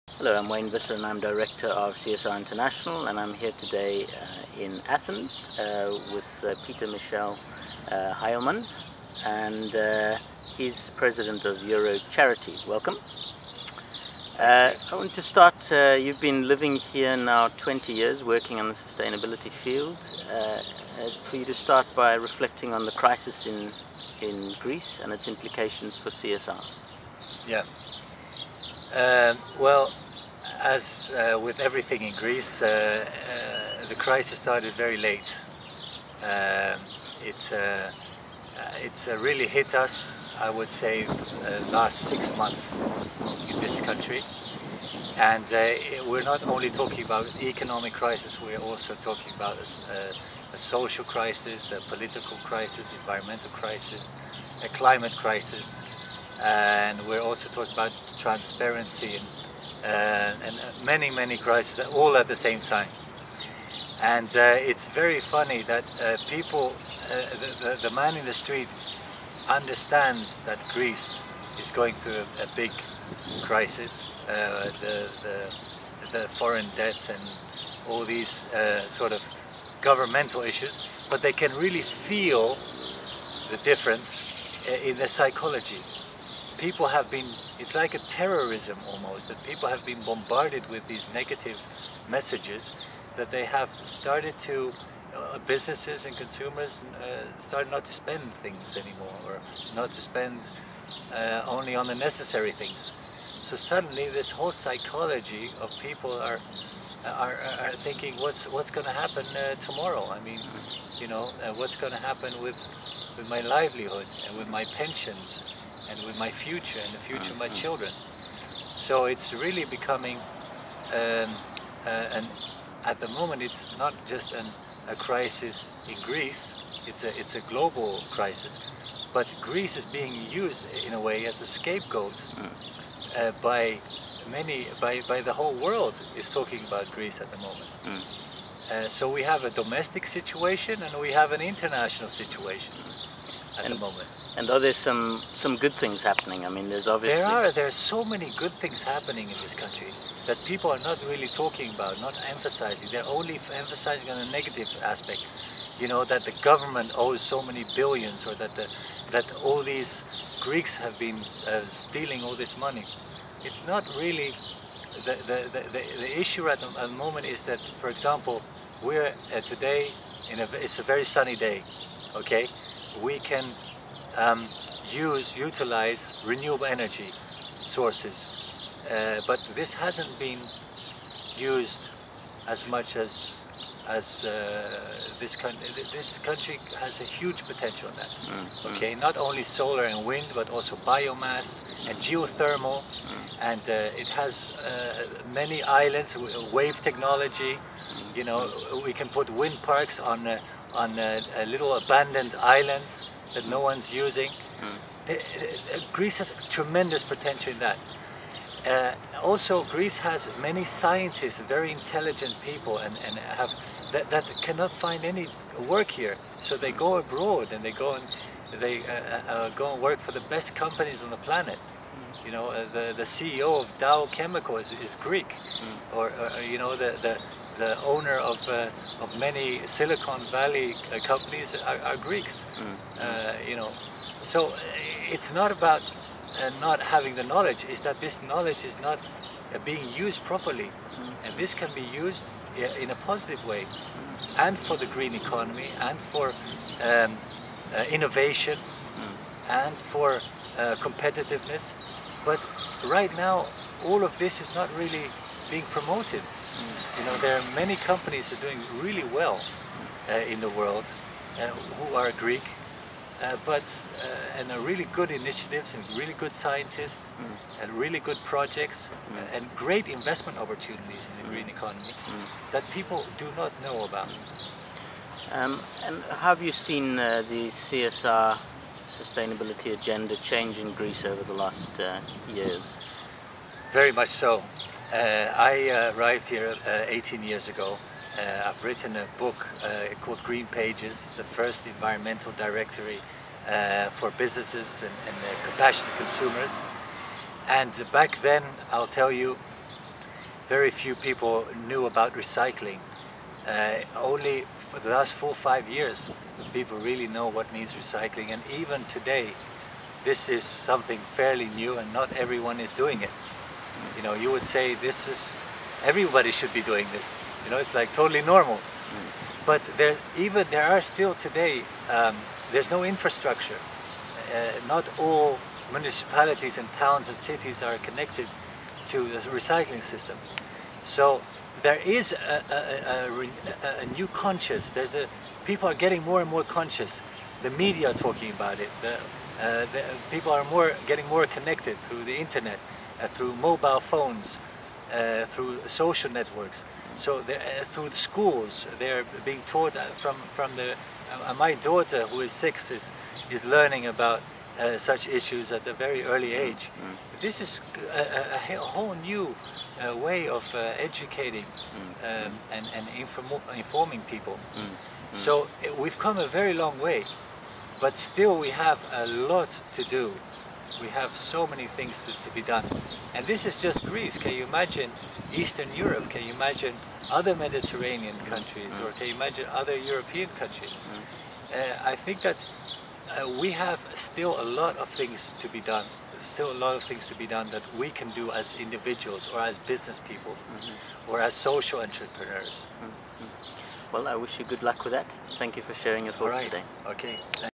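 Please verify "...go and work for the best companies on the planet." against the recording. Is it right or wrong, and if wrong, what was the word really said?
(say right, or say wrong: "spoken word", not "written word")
right.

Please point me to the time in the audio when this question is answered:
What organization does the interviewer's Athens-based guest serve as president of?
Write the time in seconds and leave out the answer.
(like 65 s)
11 s.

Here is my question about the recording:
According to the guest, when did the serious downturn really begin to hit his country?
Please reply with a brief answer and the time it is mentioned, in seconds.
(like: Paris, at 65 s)
last six months, at 41 s.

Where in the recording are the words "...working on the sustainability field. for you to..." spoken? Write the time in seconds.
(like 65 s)
18 s.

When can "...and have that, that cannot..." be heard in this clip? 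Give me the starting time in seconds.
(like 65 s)
213 s.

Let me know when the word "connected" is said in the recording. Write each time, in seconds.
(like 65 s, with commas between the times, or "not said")
327 s, 341 s.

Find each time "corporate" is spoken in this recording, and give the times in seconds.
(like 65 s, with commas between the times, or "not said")
not said.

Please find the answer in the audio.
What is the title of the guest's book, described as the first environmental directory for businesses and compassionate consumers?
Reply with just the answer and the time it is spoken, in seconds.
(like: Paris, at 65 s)
Green Pages, at 290 s.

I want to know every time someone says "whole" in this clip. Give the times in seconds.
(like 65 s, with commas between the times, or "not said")
104 s, 135 s, 358 s.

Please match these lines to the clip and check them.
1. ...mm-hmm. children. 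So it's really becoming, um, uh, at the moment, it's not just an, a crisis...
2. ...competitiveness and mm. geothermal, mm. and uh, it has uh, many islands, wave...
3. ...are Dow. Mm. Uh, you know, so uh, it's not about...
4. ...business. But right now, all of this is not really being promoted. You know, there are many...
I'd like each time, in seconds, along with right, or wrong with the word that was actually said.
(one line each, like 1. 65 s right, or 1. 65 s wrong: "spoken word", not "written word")
1. 117 s right
2. 190 s wrong: "biomass", not "competitiveness"
3. 231 s wrong: "Greeks", not "Dow"
4. 250 s wrong: "competitiveness", not "business".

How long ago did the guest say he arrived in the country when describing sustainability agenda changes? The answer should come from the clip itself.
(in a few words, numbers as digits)
18 years.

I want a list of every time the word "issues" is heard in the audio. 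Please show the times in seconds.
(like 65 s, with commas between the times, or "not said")
80 s, 166 s, 355 s.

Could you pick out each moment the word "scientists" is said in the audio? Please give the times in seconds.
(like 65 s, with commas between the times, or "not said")
210 s, 266 s.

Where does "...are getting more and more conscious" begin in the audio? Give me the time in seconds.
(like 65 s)
335 s.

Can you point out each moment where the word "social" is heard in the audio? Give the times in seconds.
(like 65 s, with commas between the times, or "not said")
50 s, 345 s, 391 s.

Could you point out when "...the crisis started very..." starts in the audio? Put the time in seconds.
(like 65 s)
33 s.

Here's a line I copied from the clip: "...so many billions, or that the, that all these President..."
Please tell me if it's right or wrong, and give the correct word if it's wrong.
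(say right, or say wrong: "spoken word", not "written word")
wrong: "Greeks", not "President".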